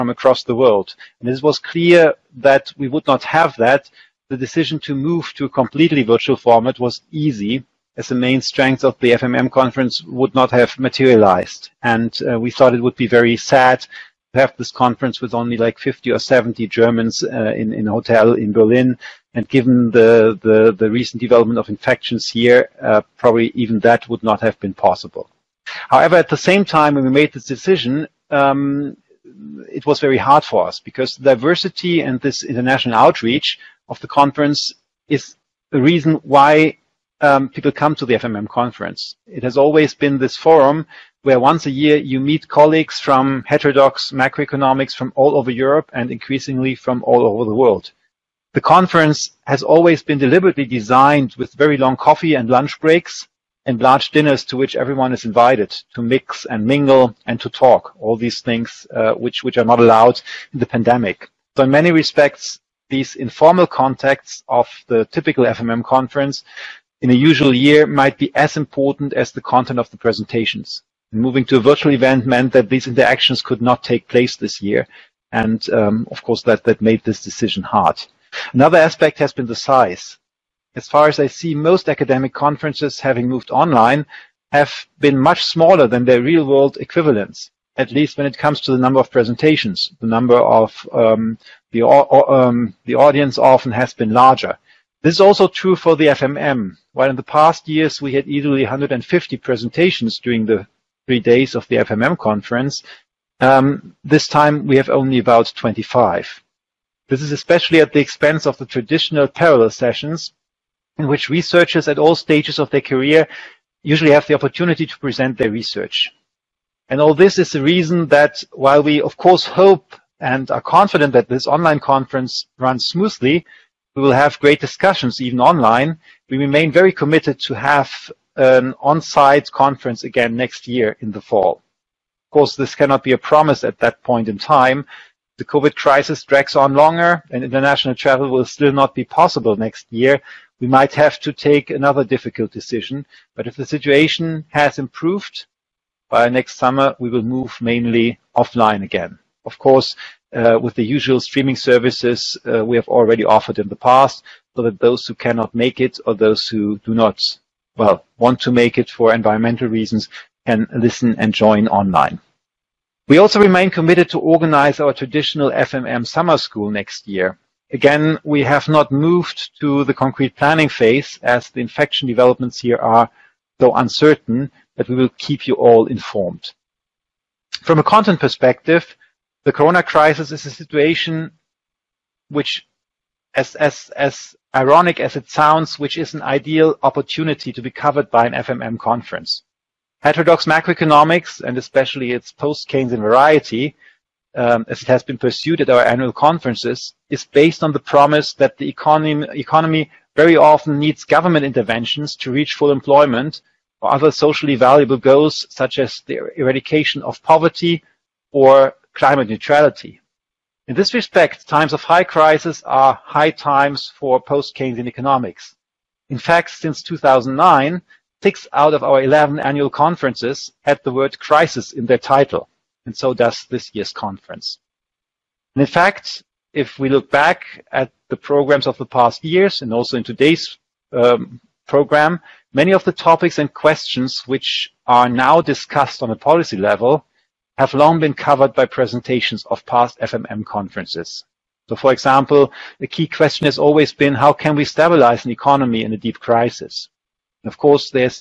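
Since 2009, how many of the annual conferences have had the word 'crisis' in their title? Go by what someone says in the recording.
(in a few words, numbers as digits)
6.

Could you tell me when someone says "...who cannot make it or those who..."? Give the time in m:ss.
2:35.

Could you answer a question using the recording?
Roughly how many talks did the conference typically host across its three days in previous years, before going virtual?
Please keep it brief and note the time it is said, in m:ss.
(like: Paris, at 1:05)
150, at 1:38.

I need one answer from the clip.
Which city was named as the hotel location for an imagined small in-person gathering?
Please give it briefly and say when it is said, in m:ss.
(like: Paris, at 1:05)
Berlin, at 0:18.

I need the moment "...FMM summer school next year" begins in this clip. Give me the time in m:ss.
2:45.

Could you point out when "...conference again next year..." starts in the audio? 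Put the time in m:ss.
2:09.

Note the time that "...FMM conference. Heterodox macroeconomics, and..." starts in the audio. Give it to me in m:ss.
3:08.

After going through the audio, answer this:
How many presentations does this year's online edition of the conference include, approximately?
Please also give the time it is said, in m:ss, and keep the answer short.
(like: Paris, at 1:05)
25, at 1:45.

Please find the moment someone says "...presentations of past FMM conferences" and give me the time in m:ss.
3:58.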